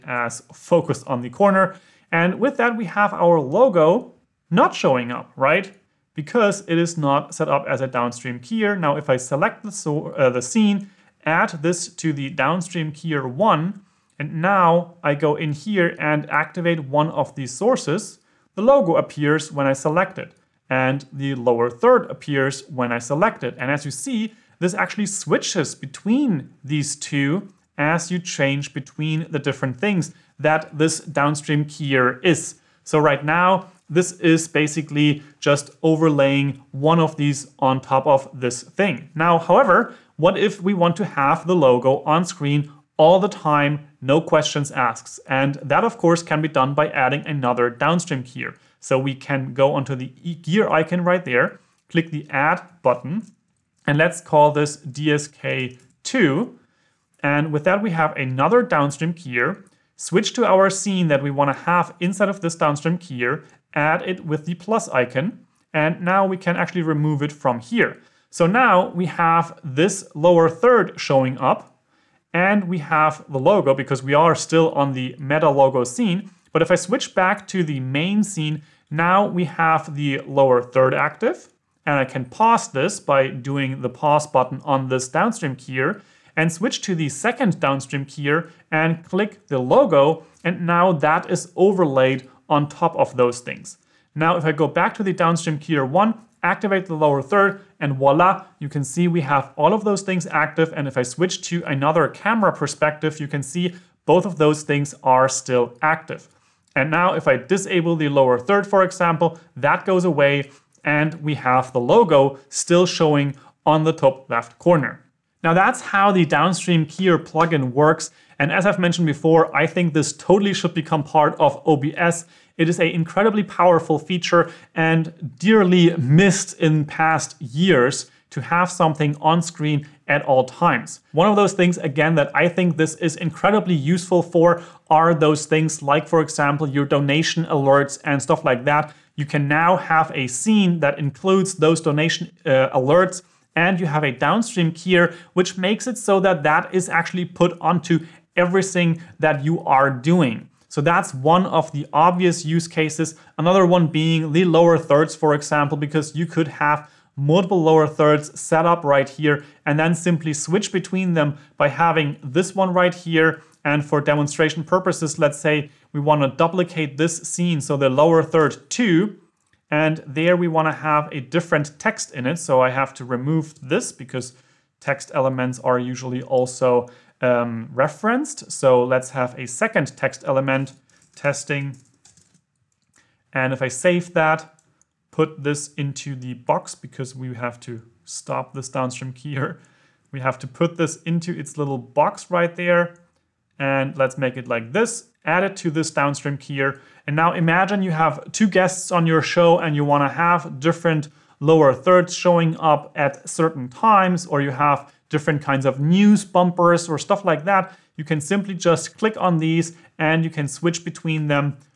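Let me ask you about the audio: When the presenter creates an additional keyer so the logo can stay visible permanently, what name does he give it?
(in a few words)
DSK2.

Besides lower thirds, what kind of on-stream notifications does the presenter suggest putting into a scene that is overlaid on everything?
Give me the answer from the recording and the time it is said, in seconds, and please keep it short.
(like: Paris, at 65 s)
Donation alerts, at 136 s.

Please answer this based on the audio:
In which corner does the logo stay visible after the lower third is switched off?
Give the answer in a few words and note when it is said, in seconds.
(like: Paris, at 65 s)
Top left, at 113 s.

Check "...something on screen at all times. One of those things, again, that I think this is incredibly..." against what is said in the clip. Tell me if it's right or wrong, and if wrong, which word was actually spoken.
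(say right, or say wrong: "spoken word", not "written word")
right.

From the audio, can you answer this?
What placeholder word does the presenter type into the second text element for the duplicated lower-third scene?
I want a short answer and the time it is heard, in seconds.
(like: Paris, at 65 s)
testing, at 181 s.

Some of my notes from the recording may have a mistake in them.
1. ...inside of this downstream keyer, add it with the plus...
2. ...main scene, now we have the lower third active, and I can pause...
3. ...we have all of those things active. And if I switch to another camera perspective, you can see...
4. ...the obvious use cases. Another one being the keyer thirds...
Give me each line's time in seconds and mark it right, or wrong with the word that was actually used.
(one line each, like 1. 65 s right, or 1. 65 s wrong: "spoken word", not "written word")
1. 62 s right
2. 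77 s right
3. 99 s right
4. 151 s wrong: "lower", not "keyer".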